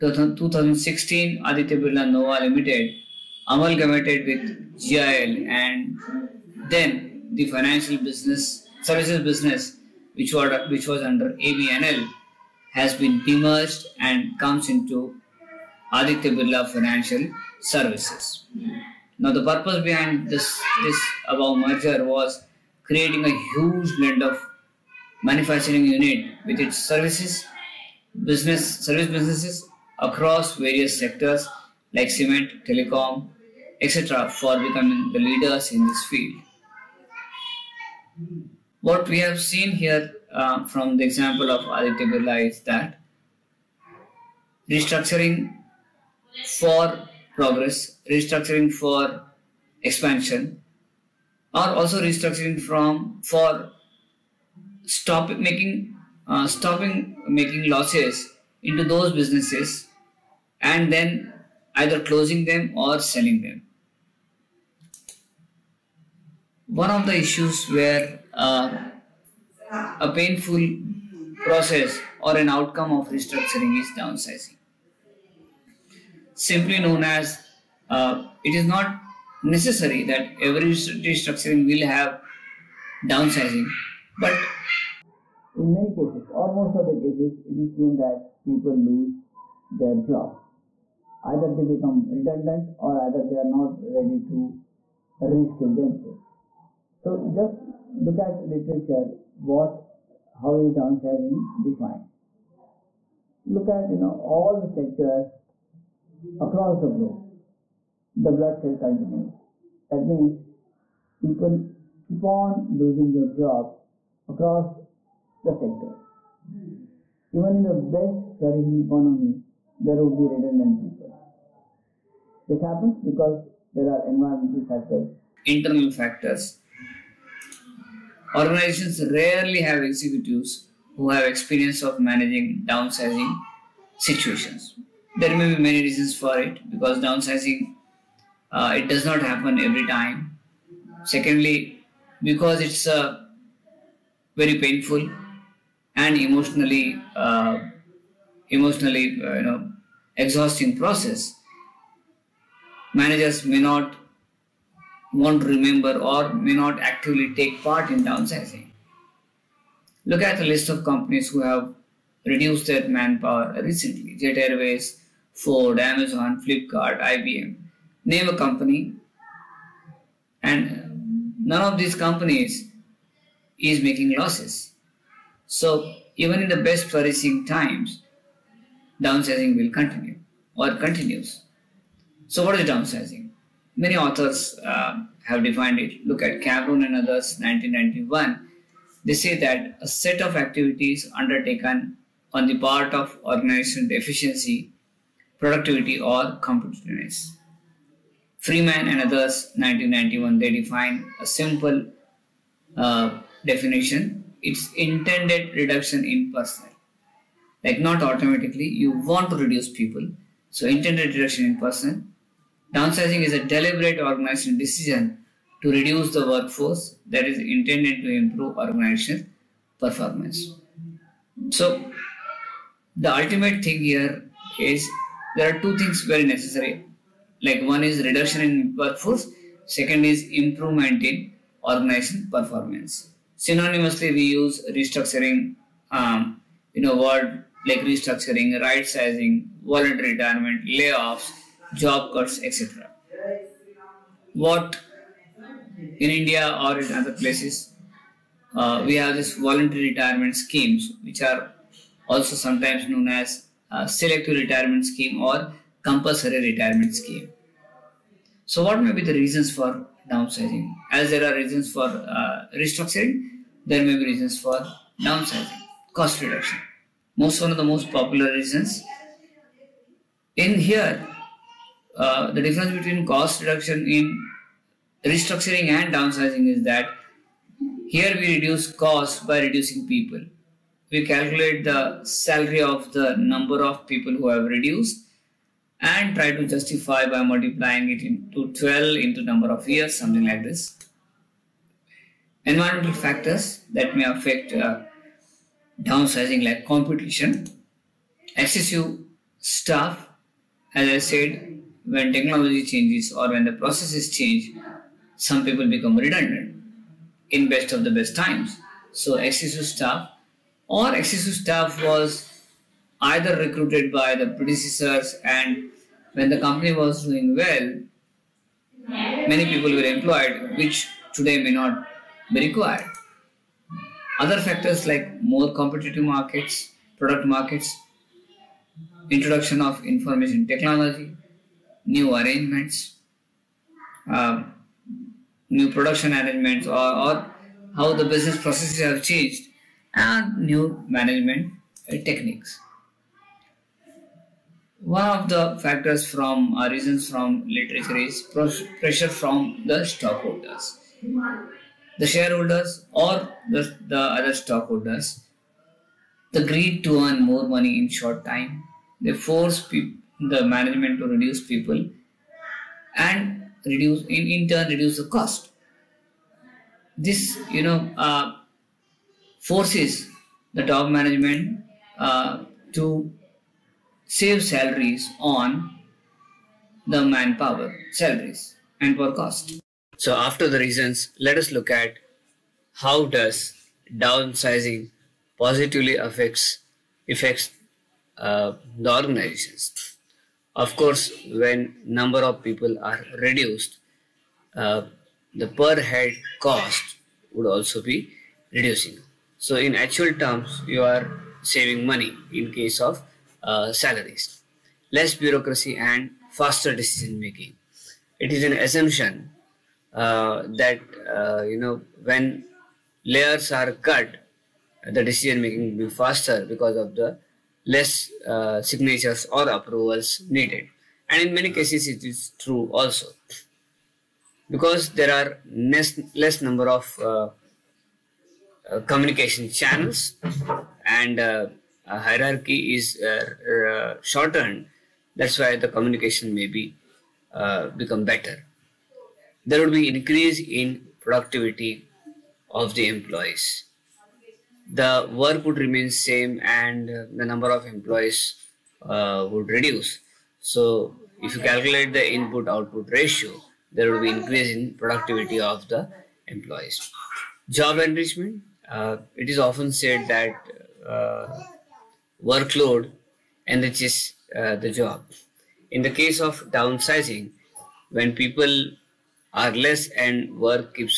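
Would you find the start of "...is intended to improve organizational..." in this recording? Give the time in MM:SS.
03:37.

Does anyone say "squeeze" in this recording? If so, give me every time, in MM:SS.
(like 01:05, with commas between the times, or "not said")
not said.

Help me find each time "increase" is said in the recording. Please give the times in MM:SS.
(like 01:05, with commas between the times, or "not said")
07:19, 07:34.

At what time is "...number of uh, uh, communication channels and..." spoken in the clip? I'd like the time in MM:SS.
07:06.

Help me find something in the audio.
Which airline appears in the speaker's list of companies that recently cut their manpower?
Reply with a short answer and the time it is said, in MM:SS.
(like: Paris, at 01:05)
Jet Airways, at 02:44.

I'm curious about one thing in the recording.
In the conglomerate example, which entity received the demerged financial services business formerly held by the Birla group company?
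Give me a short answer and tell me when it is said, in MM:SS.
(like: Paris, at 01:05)
Aditya Birla Financial Services, at 00:15.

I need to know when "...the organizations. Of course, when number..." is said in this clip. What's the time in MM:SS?
06:28.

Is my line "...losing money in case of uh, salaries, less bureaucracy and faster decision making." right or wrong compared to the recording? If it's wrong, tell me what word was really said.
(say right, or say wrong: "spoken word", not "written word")
wrong: "saving", not "losing".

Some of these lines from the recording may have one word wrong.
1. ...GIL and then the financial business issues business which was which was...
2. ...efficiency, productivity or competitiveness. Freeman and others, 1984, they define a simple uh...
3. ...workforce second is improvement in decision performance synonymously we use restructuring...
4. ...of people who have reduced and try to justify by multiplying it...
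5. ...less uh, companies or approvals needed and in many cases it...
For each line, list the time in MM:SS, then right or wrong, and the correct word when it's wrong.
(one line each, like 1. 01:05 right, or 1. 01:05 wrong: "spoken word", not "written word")
1. 00:04 wrong: "services", not "issues"
2. 03:13 wrong: "1991", not "1984"
3. 03:48 wrong: "organization", not "decision"
4. 04:43 right
5. 06:57 wrong: "signatures", not "companies".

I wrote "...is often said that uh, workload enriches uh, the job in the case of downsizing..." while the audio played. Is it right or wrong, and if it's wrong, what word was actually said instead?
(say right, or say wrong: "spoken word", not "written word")
right.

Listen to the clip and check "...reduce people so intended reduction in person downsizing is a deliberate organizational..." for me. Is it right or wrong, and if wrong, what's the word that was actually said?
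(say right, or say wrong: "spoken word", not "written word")
right.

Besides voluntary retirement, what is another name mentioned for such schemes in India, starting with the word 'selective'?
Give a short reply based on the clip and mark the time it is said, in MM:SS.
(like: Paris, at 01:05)
selective retirement scheme, at 04:13.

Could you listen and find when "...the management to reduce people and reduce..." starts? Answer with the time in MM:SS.
05:59.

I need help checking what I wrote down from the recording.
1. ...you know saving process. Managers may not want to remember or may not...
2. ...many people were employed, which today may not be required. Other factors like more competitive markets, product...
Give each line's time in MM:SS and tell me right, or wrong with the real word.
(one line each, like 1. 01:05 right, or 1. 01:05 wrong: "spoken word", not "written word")
1. 02:29 wrong: "exhausting", not "saving"
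2. 05:18 right.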